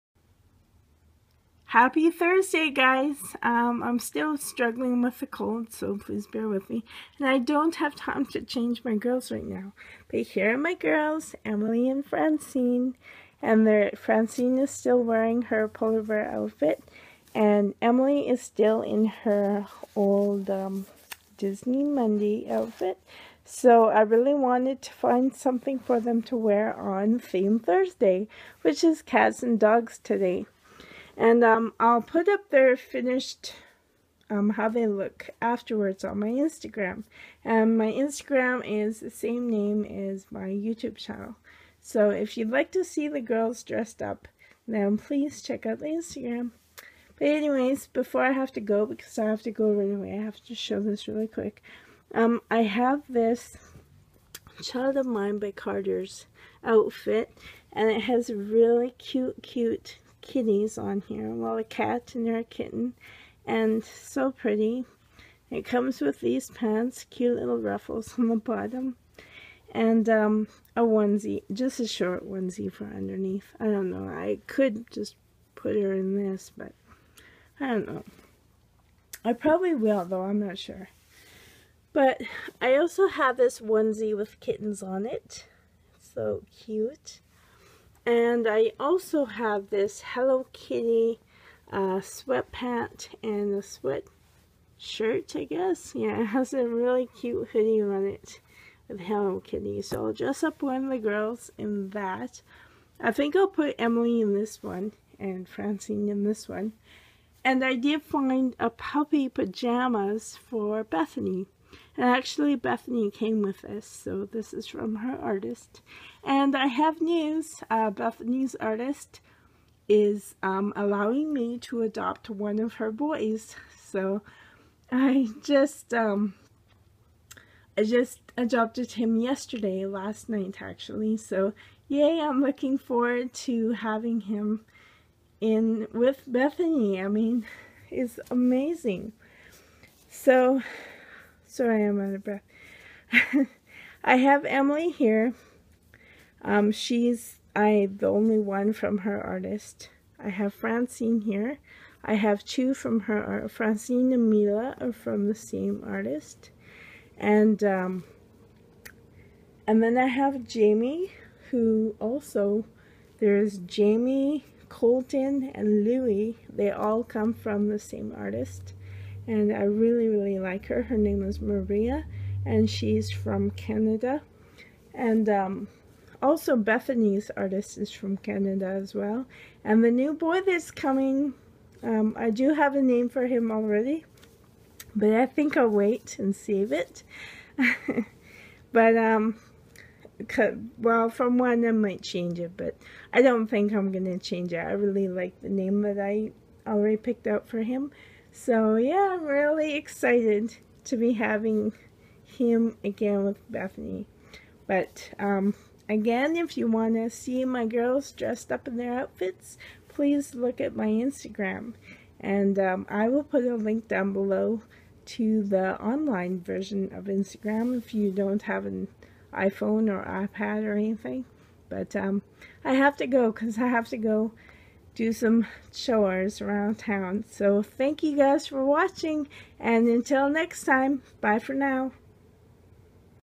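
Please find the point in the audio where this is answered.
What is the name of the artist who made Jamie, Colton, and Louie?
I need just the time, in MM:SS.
02:51.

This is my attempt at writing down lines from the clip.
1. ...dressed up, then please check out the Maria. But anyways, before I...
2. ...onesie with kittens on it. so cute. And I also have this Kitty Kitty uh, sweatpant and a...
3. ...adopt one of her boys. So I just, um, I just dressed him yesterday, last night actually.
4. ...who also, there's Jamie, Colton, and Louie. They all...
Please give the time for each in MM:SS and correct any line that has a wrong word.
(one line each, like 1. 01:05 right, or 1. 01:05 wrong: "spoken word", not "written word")
1. 00:43 wrong: "Instagram", not "Maria"
2. 01:23 wrong: "Hello", not "Kitty"
3. 02:01 wrong: "adopted", not "dressed"
4. 02:41 right.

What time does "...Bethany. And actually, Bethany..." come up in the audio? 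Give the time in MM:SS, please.
01:50.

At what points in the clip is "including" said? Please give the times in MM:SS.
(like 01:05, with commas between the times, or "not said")
not said.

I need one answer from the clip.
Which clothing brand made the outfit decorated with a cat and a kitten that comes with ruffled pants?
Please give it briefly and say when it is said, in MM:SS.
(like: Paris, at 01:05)
Child of Mine by Carter's, at 00:54.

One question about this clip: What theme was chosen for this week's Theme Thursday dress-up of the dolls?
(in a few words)
Cats and dogs.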